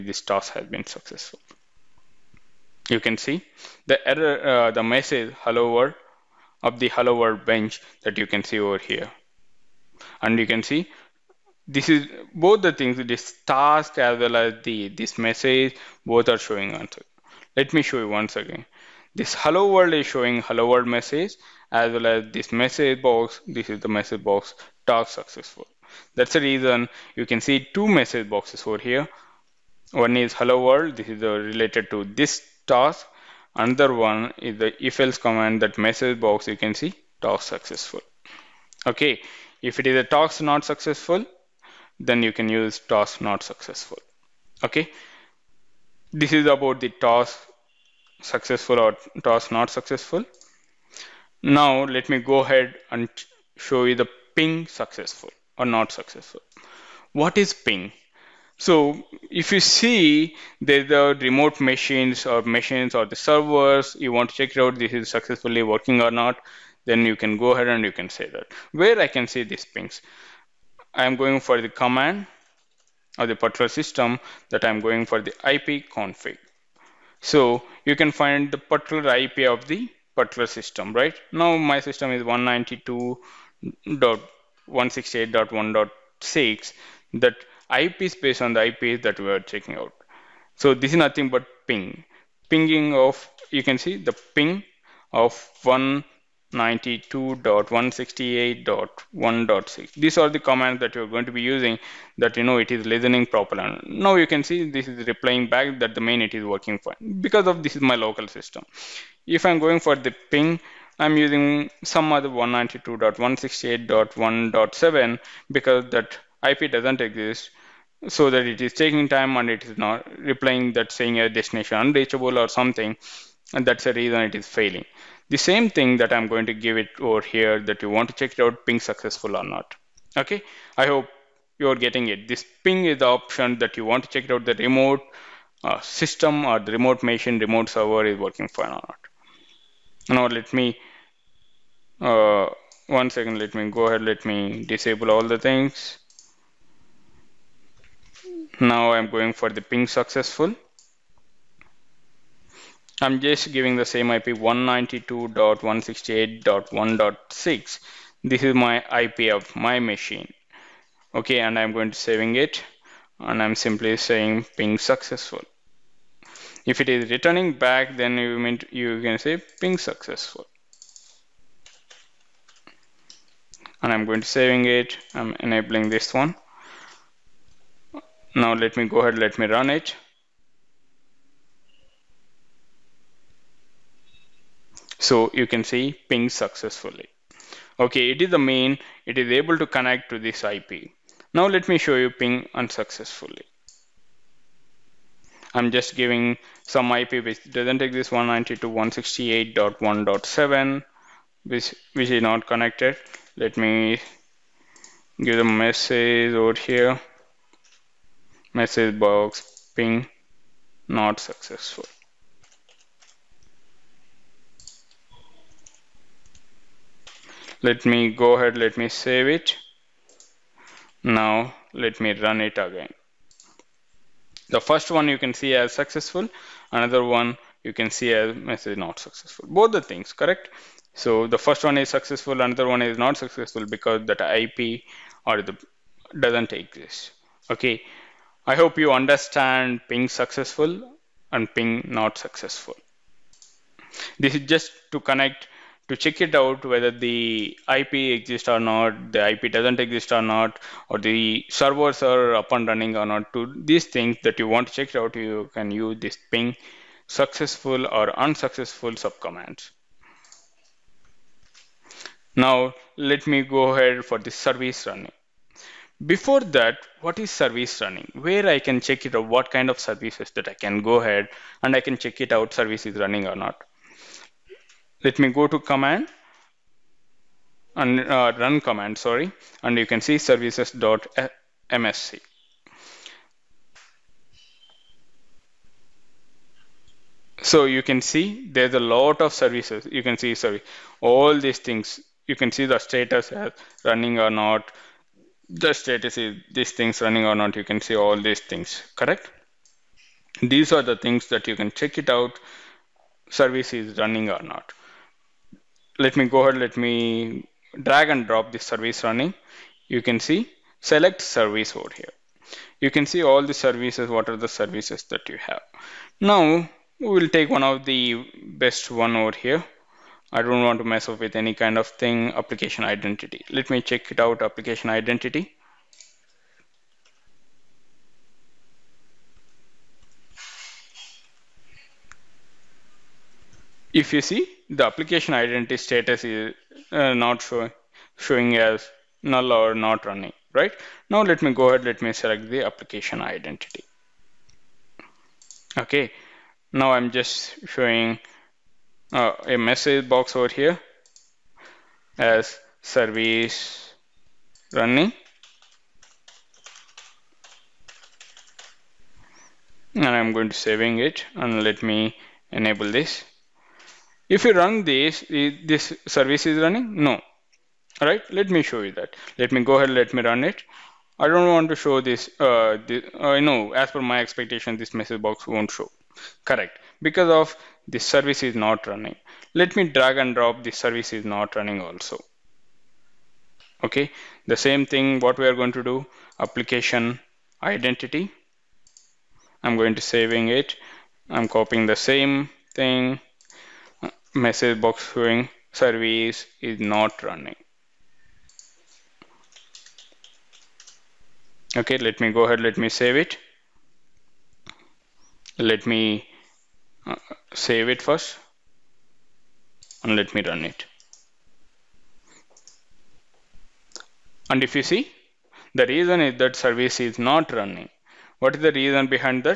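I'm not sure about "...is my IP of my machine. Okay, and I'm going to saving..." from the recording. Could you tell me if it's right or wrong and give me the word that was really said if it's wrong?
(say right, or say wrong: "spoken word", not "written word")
right.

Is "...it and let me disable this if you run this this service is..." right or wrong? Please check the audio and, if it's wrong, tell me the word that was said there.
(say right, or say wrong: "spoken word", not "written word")
wrong: "enable", not "disable".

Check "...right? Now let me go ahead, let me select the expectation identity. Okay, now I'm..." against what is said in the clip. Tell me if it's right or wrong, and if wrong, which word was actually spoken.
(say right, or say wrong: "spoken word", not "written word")
wrong: "application", not "expectation".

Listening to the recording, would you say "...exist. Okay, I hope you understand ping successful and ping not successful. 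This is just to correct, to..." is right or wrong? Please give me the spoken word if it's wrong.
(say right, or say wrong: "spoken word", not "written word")
wrong: "connect", not "correct".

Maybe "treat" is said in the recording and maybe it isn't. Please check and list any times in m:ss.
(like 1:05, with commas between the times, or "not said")
not said.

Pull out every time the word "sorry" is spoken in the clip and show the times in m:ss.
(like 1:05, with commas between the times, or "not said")
4:38, 4:50.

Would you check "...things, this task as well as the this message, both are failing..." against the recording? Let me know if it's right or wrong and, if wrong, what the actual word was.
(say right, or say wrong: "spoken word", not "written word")
wrong: "showing", not "failing".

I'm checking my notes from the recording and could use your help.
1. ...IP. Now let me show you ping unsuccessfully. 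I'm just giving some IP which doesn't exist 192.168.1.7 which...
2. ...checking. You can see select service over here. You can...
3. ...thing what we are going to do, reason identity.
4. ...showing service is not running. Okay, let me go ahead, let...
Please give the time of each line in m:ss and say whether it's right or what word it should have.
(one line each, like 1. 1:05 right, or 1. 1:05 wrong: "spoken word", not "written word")
1. 3:10 right
2. 5:09 wrong: "running", not "checking"
3. 6:24 wrong: "application", not "reason"
4. 6:35 right.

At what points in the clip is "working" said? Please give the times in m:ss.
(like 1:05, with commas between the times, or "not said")
1:05, 1:46, 2:18.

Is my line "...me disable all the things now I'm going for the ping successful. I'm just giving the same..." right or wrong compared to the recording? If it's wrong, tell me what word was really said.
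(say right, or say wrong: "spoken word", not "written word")
right.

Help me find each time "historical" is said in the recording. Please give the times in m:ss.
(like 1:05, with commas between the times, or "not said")
not said.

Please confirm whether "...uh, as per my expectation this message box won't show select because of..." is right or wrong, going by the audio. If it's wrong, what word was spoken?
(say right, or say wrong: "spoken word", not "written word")
wrong: "correct", not "select".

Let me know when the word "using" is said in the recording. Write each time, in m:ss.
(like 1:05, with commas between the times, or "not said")
1:41, 1:51.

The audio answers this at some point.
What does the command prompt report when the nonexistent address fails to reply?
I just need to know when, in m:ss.
2:01.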